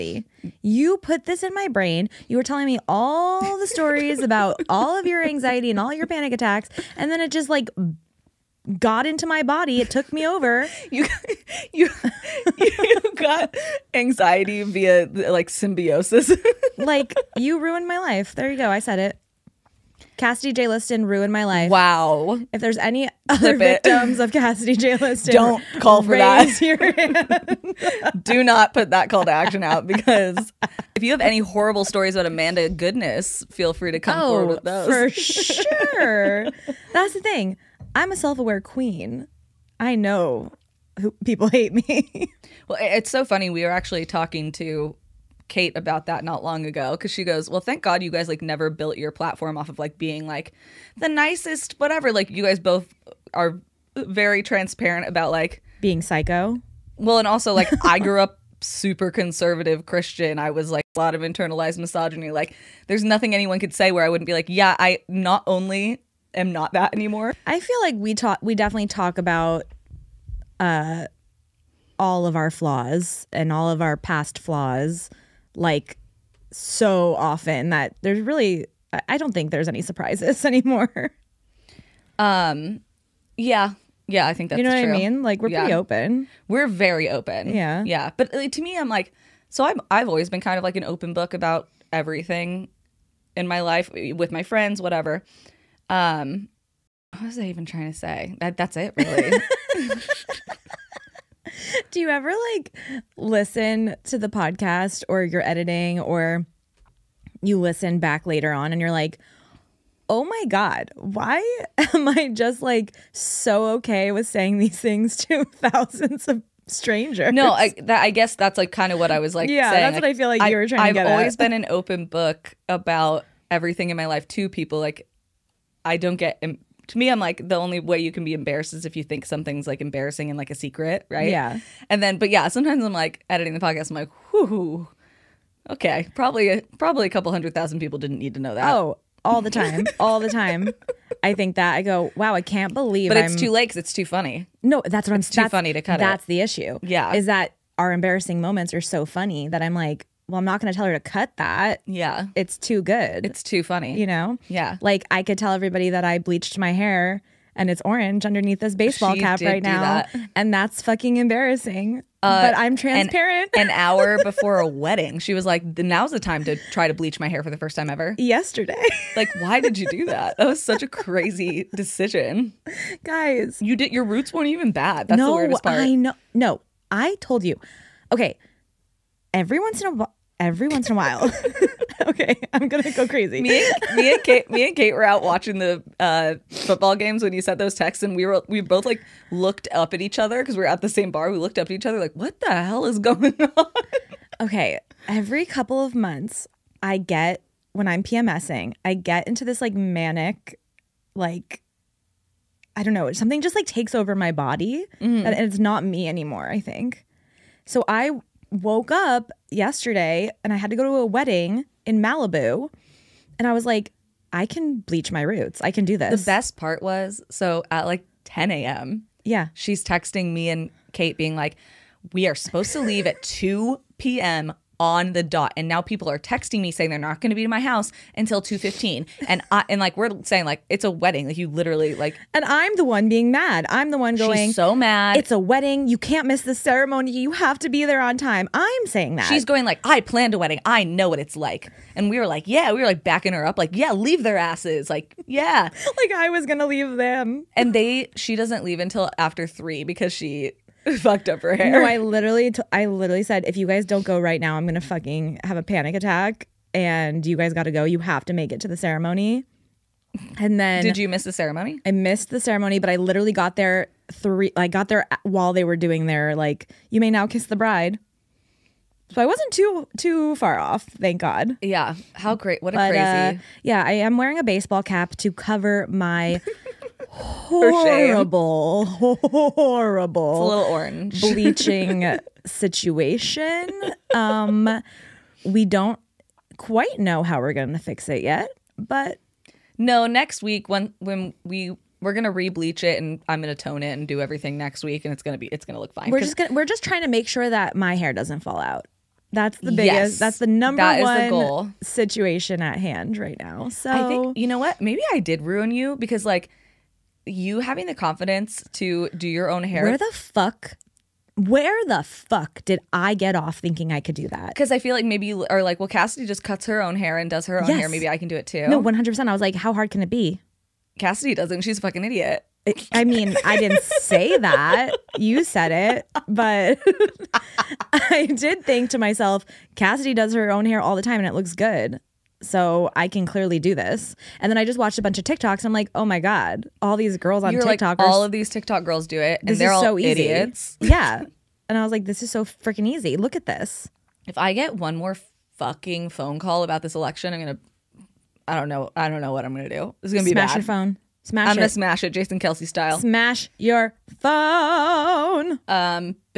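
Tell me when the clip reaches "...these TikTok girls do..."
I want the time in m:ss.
5:38.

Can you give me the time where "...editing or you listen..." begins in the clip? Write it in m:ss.
1:45.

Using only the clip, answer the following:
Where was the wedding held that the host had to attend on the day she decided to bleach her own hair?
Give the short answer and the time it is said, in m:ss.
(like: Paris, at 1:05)
Malibu, at 3:31.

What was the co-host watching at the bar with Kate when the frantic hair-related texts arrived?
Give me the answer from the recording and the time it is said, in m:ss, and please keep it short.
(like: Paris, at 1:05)
football games, at 3:06.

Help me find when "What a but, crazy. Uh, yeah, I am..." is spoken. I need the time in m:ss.
4:32.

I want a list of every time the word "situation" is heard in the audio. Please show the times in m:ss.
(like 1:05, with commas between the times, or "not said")
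4:42, 5:01.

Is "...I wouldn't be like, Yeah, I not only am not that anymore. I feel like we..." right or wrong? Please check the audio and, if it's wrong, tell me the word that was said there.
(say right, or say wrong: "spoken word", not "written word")
right.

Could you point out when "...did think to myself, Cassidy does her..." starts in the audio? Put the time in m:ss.
5:28.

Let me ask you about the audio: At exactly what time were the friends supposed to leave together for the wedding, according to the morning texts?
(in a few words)
2 p.m.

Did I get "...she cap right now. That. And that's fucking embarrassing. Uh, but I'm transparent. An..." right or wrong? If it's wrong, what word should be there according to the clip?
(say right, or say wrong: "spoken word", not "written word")
right.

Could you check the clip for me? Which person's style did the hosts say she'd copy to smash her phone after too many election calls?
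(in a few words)
Jason Kelce.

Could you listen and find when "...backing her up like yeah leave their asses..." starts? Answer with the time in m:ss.
4:03.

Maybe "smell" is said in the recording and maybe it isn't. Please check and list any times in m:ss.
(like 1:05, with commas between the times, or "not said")
not said.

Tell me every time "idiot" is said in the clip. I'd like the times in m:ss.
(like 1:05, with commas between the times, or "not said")
5:22, 5:39.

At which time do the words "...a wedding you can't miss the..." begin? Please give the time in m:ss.
3:55.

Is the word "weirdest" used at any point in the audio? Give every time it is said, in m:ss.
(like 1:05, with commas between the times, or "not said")
2:55.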